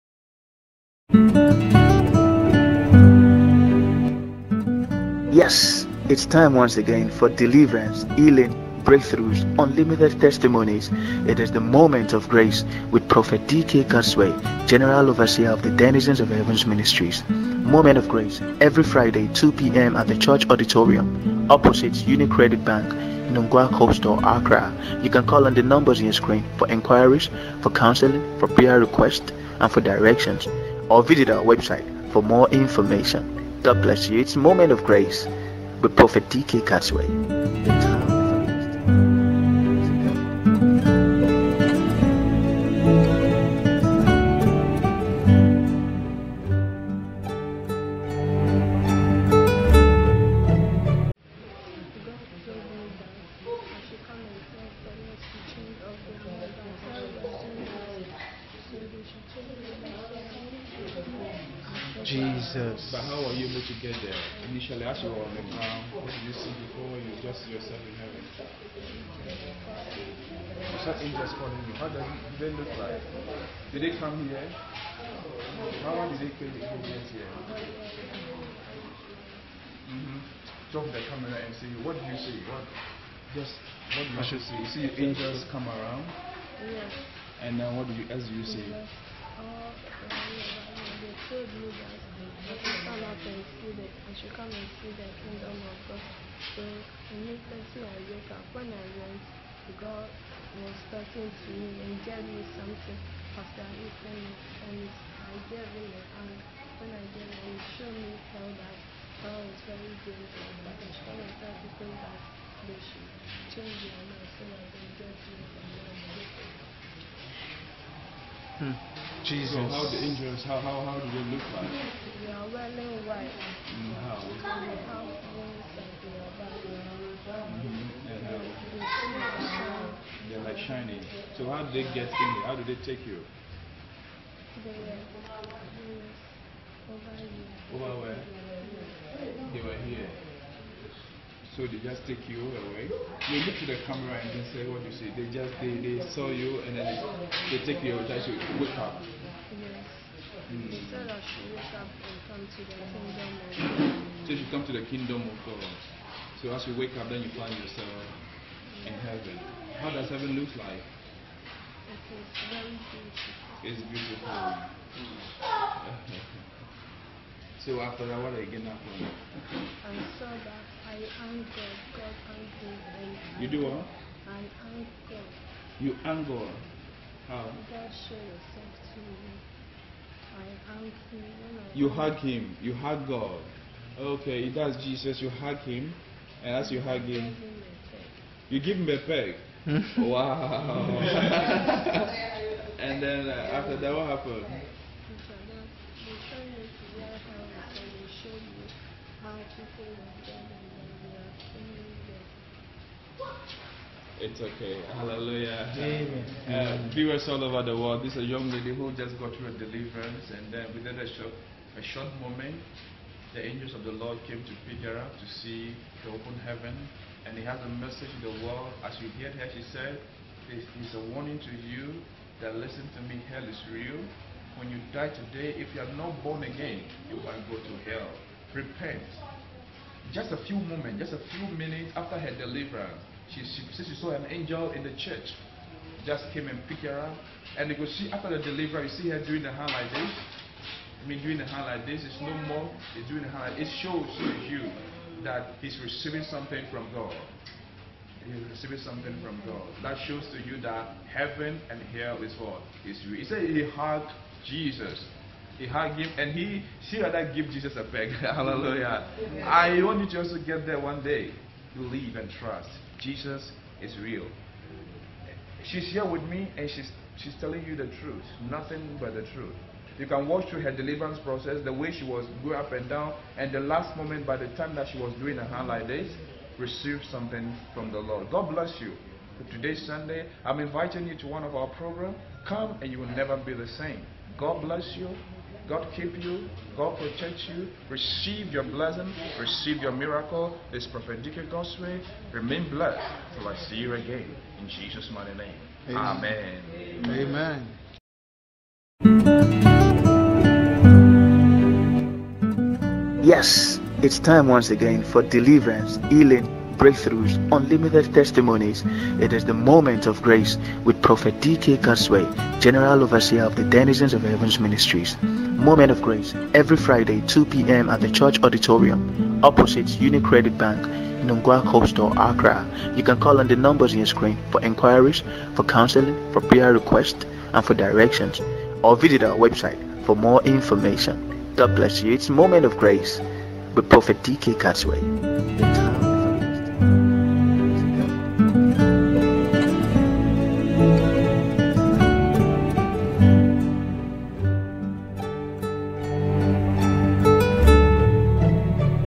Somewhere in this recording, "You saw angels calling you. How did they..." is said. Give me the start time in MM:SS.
01:09.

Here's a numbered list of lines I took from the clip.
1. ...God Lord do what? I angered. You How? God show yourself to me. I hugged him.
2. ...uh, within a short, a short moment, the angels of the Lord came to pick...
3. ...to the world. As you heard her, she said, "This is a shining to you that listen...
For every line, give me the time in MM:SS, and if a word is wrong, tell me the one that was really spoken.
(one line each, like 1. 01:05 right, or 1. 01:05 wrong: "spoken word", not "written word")
1. 02:51 wrong: "You", not "Lord"
2. 03:30 right
3. 03:38 wrong: "warning", not "shining".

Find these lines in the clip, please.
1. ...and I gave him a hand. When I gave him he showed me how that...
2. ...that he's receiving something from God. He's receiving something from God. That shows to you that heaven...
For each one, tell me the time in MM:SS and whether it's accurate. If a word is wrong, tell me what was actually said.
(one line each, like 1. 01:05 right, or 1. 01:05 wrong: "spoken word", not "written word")
1. 01:44 right
2. 04:05 right.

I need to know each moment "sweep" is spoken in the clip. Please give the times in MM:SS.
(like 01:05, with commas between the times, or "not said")
not said.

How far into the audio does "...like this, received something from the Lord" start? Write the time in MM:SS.
04:35.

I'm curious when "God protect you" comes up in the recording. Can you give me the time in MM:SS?
04:46.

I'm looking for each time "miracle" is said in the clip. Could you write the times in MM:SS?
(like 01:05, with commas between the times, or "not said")
04:49.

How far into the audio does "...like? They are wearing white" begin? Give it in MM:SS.
02:01.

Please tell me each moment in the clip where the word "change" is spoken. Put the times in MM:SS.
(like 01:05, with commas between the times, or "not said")
01:53.